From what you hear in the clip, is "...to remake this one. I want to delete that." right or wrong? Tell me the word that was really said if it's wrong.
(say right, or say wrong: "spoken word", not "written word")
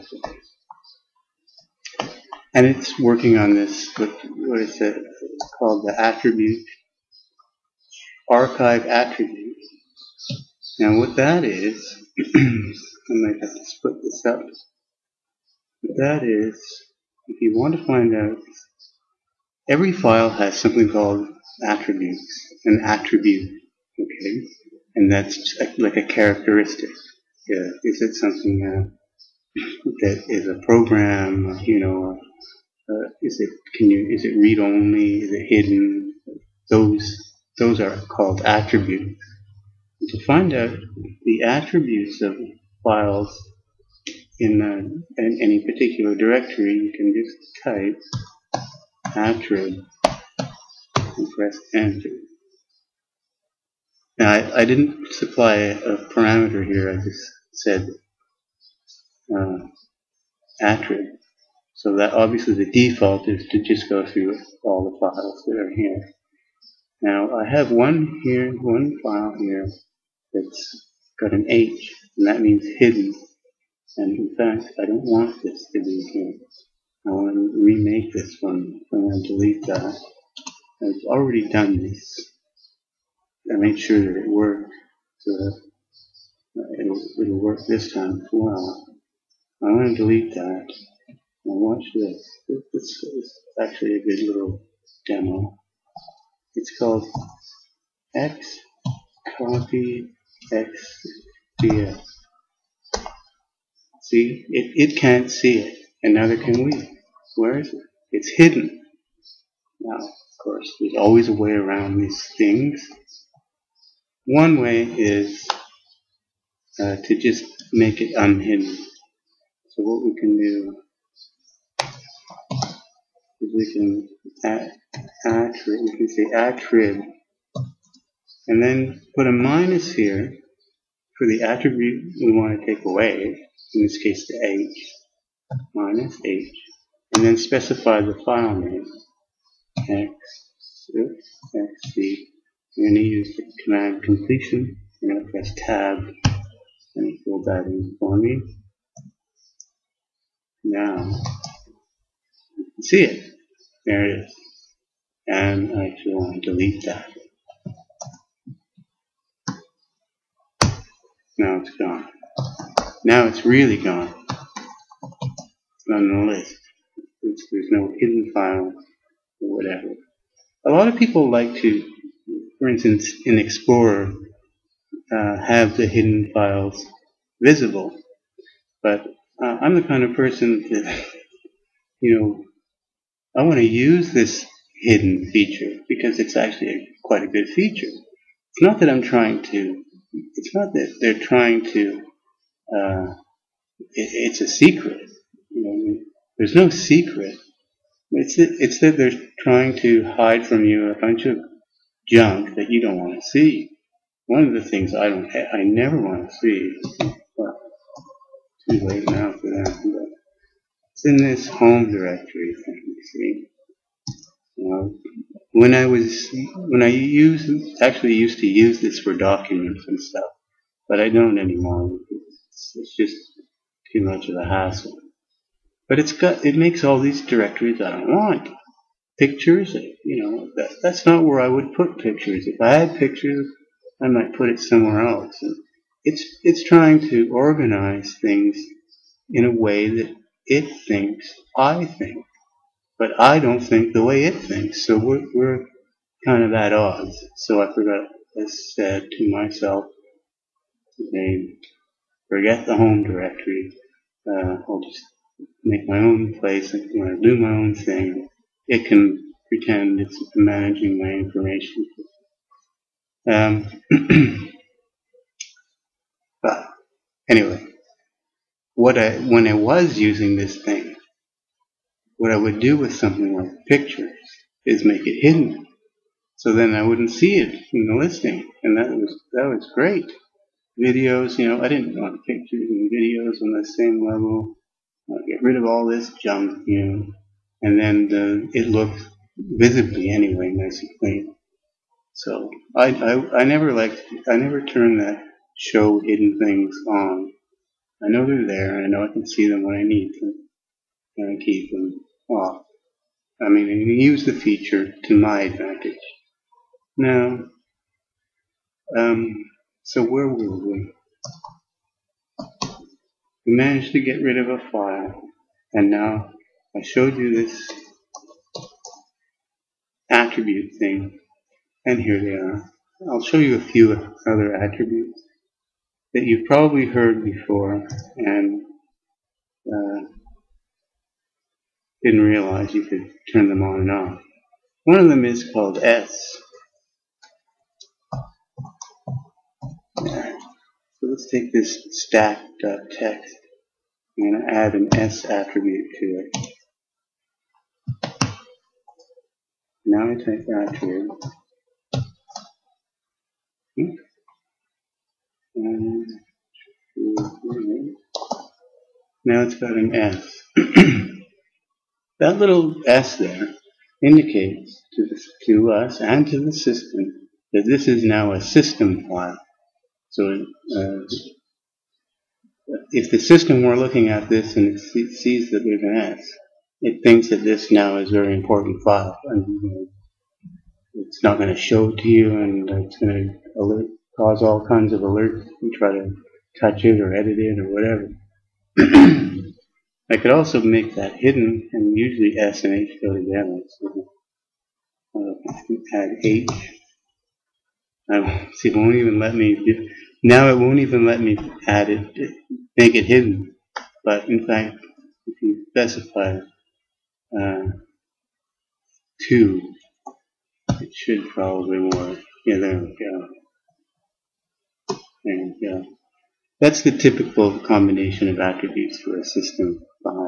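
right.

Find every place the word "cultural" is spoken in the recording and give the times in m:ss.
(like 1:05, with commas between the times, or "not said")
not said.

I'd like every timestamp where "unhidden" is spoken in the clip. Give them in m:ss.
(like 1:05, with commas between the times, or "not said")
1:58.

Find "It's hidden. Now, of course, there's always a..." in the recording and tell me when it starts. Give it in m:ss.
1:48.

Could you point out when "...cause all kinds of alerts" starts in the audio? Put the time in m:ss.
6:24.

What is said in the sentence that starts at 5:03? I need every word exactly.
I mean, use the feature to my advantage.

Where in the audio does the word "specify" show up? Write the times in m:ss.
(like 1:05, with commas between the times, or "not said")
2:17, 6:45.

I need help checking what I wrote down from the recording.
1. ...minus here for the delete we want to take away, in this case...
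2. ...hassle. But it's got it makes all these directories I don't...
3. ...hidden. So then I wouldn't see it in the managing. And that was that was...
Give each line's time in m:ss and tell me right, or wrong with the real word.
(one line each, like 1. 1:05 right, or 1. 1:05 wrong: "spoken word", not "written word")
1. 2:09 wrong: "attribute", not "delete"
2. 3:44 right
3. 4:35 wrong: "listing", not "managing".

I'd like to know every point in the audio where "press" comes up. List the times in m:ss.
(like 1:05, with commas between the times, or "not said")
0:51, 2:25.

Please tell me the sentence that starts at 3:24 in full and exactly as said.
One of the things I don't, I never want to see.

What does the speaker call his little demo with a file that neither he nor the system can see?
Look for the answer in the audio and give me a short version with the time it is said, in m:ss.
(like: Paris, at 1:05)
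X copy, at 1:38.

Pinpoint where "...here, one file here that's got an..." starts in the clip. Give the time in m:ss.
1:08.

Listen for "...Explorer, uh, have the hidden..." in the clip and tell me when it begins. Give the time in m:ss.
2:53.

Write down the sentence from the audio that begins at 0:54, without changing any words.
Now, I, I didn't supply a parameter here, I just said uh, attrib.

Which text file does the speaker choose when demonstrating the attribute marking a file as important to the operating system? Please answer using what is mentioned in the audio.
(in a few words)
stack.text.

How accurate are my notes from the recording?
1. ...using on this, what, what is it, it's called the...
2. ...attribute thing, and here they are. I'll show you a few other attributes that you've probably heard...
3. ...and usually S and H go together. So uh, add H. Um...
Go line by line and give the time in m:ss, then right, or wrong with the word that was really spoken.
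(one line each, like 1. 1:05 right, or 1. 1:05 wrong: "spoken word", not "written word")
1. 0:02 wrong: "working", not "using"
2. 5:20 right
3. 6:31 right.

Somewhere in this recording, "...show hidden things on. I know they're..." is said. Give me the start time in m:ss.
4:55.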